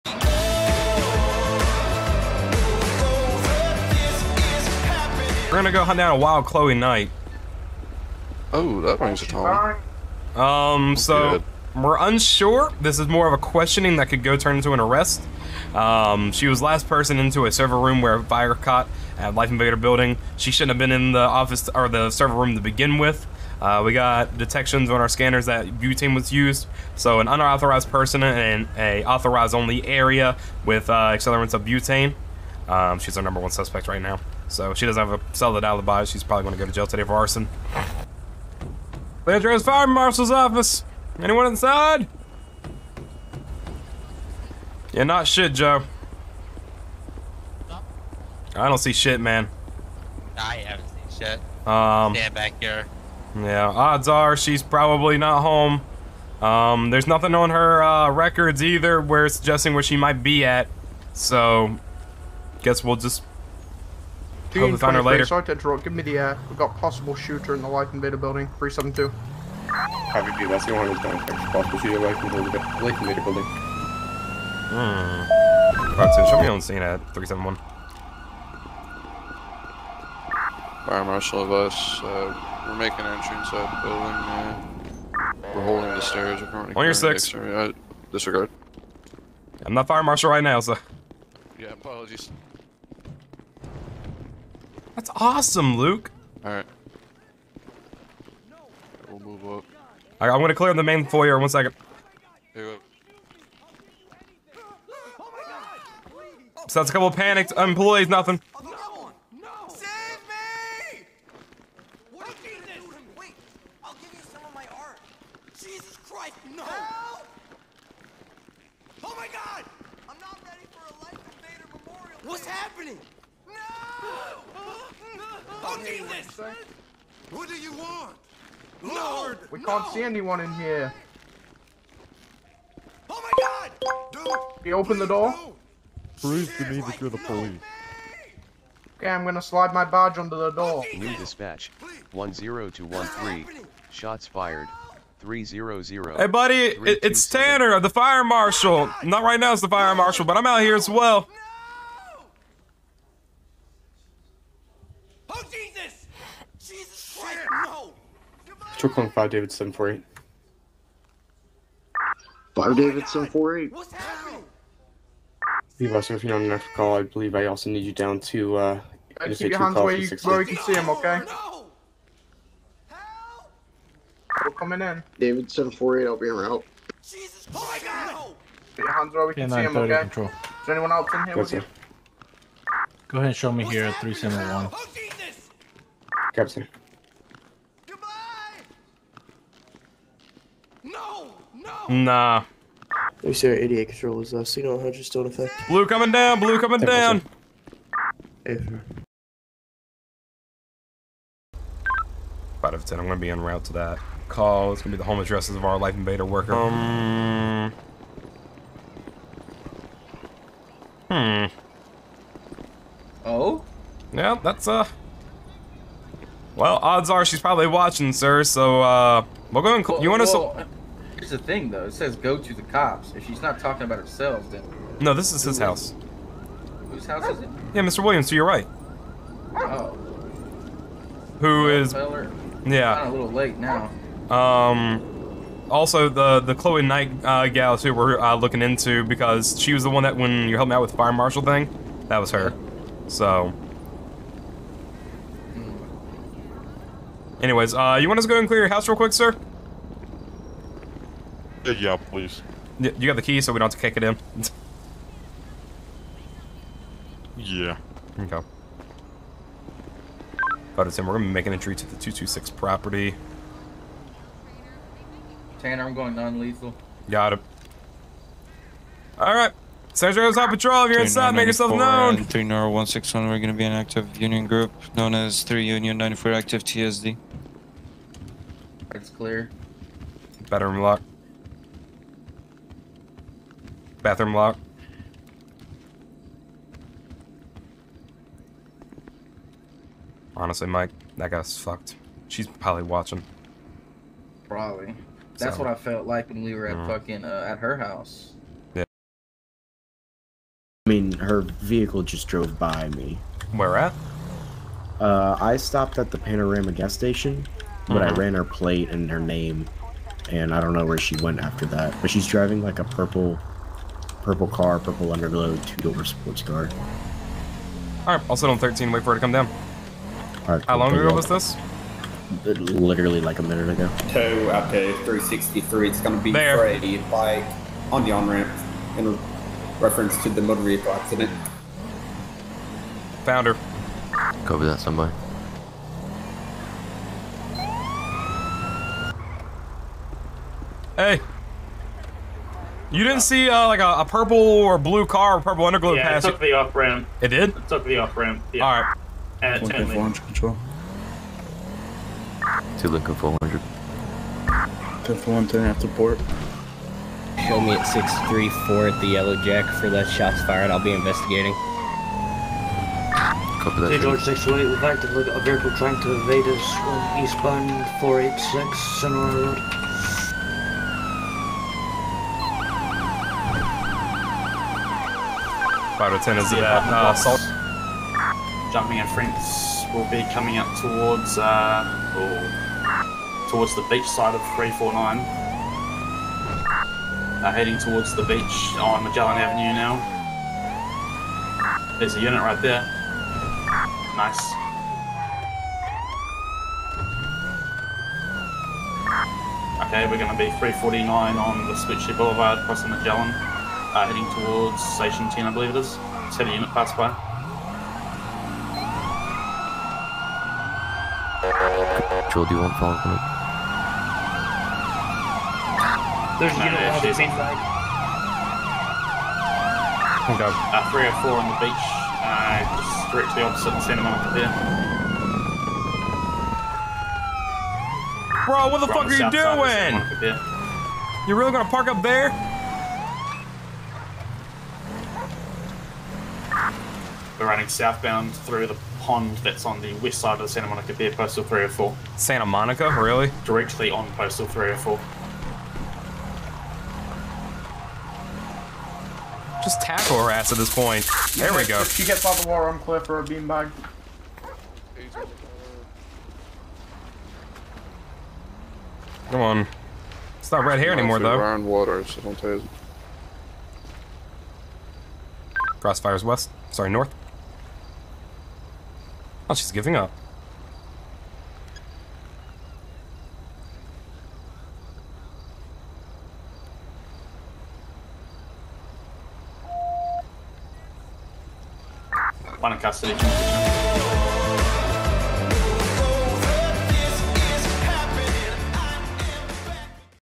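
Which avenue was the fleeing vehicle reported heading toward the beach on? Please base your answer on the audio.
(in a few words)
Magellan Avenue.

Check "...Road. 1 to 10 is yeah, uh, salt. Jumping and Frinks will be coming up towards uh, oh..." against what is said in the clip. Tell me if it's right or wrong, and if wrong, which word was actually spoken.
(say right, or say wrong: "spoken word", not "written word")
wrong: "5", not "1".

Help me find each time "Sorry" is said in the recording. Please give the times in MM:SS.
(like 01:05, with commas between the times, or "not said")
01:05, 07:46.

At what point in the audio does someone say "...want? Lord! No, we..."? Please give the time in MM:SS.
02:07.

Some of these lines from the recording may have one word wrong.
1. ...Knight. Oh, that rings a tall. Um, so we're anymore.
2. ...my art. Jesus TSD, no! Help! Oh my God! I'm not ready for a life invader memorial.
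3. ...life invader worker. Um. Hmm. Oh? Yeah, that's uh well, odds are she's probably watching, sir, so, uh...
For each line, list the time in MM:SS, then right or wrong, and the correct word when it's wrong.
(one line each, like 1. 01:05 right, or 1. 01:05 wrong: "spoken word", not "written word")
1. 00:06 wrong: "unsure", not "anymore"
2. 01:54 wrong: "Christ", not "TSD"
3. 03:25 right.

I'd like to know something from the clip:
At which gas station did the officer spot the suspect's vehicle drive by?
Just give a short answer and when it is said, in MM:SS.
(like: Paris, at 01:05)
Panorama, at 05:06.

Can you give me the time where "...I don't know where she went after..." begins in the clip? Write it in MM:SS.
05:10.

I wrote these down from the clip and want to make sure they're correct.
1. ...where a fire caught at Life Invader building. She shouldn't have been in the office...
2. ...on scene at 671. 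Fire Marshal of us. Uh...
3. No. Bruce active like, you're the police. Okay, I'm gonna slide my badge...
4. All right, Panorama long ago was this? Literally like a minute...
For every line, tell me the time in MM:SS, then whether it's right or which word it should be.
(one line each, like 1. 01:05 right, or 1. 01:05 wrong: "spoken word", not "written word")
1. 00:18 right
2. 01:16 wrong: "371", not "671"
3. 02:15 wrong: "believe", not "active"
4. 05:20 wrong: "How", not "Panorama".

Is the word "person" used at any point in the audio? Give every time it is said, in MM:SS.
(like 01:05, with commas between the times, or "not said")
00:16, 00:27.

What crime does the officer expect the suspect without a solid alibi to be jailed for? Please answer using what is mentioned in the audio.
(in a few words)
arson.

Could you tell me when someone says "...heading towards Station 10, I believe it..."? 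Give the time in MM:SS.
06:44.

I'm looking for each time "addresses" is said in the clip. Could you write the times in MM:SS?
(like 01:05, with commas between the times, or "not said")
03:25.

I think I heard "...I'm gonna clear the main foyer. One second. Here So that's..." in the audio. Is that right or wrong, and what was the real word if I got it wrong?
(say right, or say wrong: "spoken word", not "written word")
right.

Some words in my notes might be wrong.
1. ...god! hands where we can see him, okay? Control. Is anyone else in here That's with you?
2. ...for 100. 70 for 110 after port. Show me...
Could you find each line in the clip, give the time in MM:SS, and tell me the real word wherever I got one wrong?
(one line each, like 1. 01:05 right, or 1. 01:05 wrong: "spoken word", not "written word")
1. 02:58 right
2. 05:53 wrong: "10", not "70".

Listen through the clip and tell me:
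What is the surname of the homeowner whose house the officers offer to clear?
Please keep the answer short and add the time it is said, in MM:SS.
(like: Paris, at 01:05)
Williams, at 03:48.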